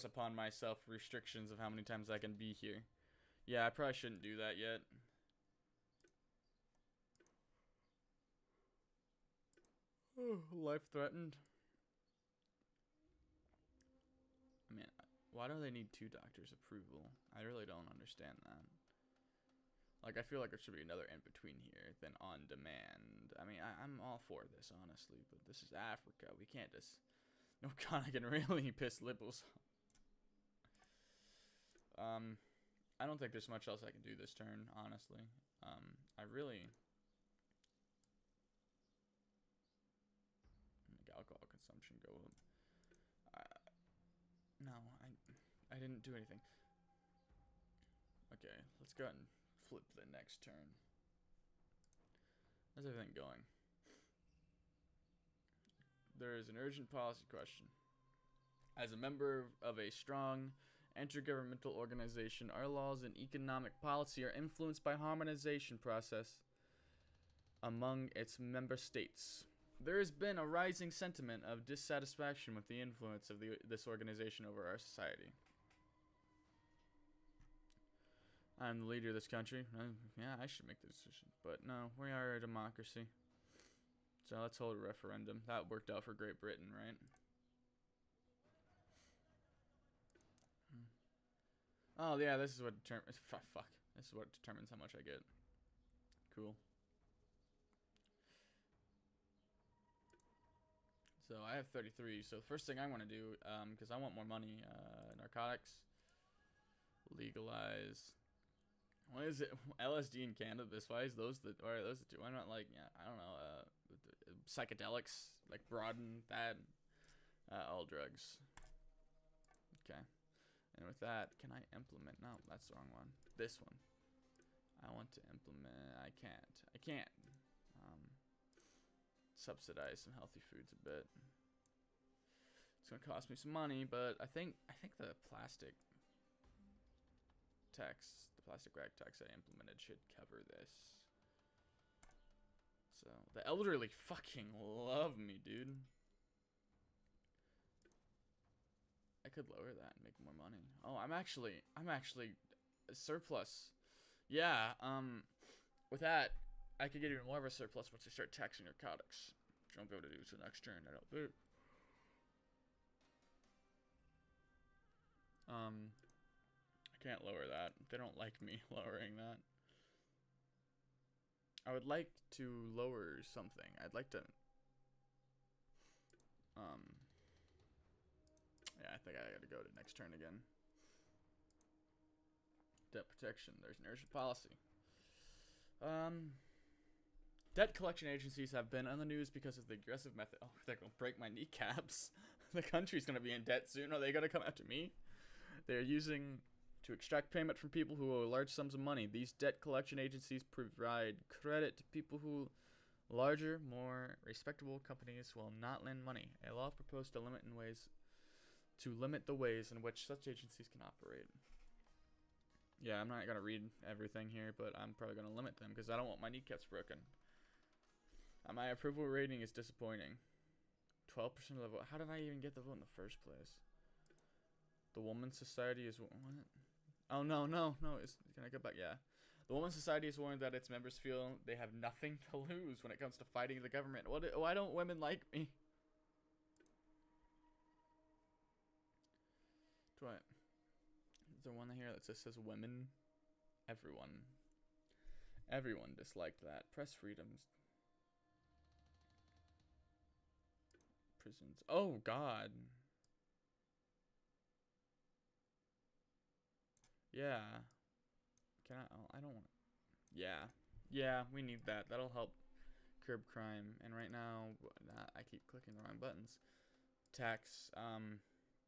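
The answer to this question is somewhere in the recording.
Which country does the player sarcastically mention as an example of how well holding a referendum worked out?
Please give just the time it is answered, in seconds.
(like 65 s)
86 s.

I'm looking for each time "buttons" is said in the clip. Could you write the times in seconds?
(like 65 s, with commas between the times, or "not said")
266 s.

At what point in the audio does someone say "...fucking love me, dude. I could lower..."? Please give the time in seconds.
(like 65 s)
143 s.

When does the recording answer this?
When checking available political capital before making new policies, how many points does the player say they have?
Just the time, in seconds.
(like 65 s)
101 s.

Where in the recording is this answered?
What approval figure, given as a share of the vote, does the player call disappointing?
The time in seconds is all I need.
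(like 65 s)
221 s.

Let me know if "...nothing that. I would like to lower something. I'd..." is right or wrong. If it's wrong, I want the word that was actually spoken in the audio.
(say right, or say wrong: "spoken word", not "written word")
wrong: "lowering", not "nothing".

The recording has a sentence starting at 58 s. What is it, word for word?
As a member of a strong intergovernmental organization, our laws and economic policy are influenced by harmonization process among its member states.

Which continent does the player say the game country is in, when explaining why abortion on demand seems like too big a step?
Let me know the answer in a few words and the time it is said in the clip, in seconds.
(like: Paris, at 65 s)
Africa, at 25 s.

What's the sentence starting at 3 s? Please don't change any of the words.
Yeah, I probably shouldn't do that yet.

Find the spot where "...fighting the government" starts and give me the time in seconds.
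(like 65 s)
233 s.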